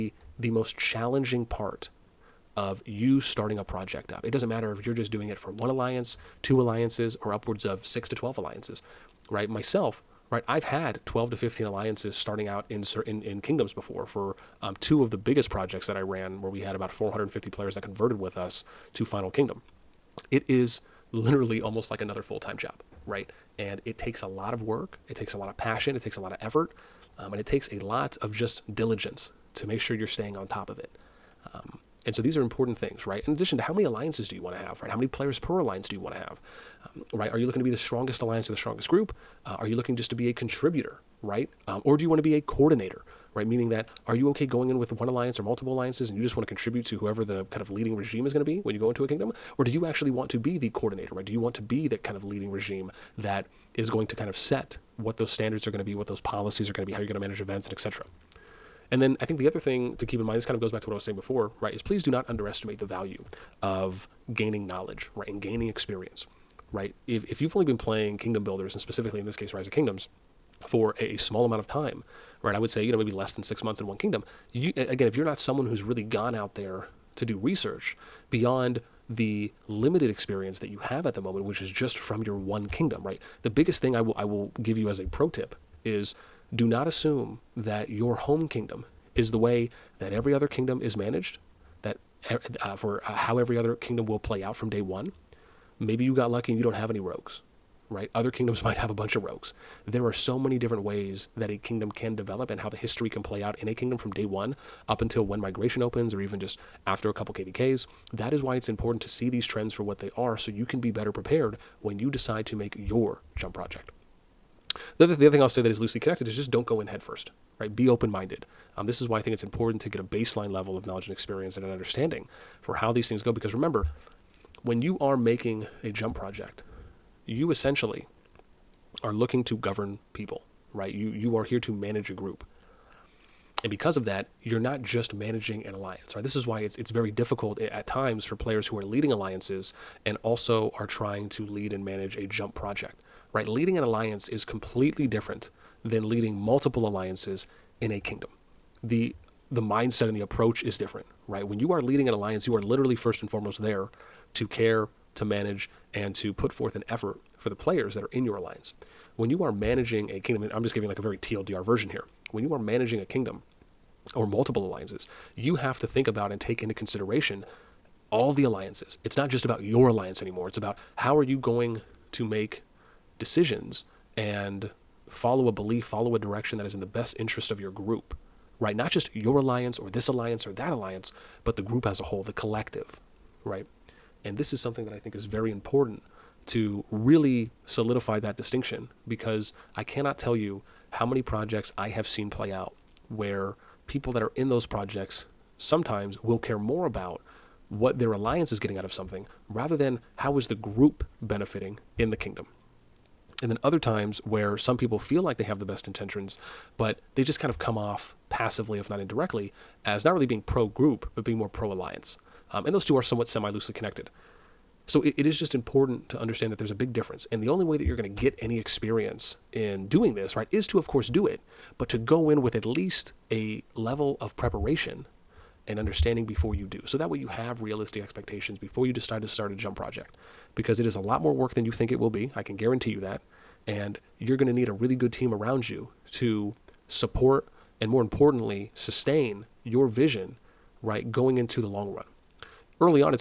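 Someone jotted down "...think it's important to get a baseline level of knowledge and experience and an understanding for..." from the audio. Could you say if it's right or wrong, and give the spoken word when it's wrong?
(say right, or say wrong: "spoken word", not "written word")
right.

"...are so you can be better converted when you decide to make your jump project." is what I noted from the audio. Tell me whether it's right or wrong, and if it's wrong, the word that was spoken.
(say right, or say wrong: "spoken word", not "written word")
wrong: "prepared", not "converted".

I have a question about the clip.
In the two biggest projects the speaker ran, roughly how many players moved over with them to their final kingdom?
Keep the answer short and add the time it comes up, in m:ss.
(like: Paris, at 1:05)
450, at 0:16.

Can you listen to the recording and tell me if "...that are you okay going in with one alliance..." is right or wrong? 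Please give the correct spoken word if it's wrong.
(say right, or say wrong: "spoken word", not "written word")
right.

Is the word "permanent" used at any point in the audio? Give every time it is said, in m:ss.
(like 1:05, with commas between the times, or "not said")
not said.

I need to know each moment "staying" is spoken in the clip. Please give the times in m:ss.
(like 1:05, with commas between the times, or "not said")
0:30.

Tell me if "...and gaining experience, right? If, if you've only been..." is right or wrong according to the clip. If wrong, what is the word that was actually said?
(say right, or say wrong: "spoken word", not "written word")
right.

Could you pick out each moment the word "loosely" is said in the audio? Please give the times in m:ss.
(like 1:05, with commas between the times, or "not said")
1:55, 3:33.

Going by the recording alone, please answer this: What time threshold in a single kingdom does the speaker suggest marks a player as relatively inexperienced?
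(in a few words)
Less than six months.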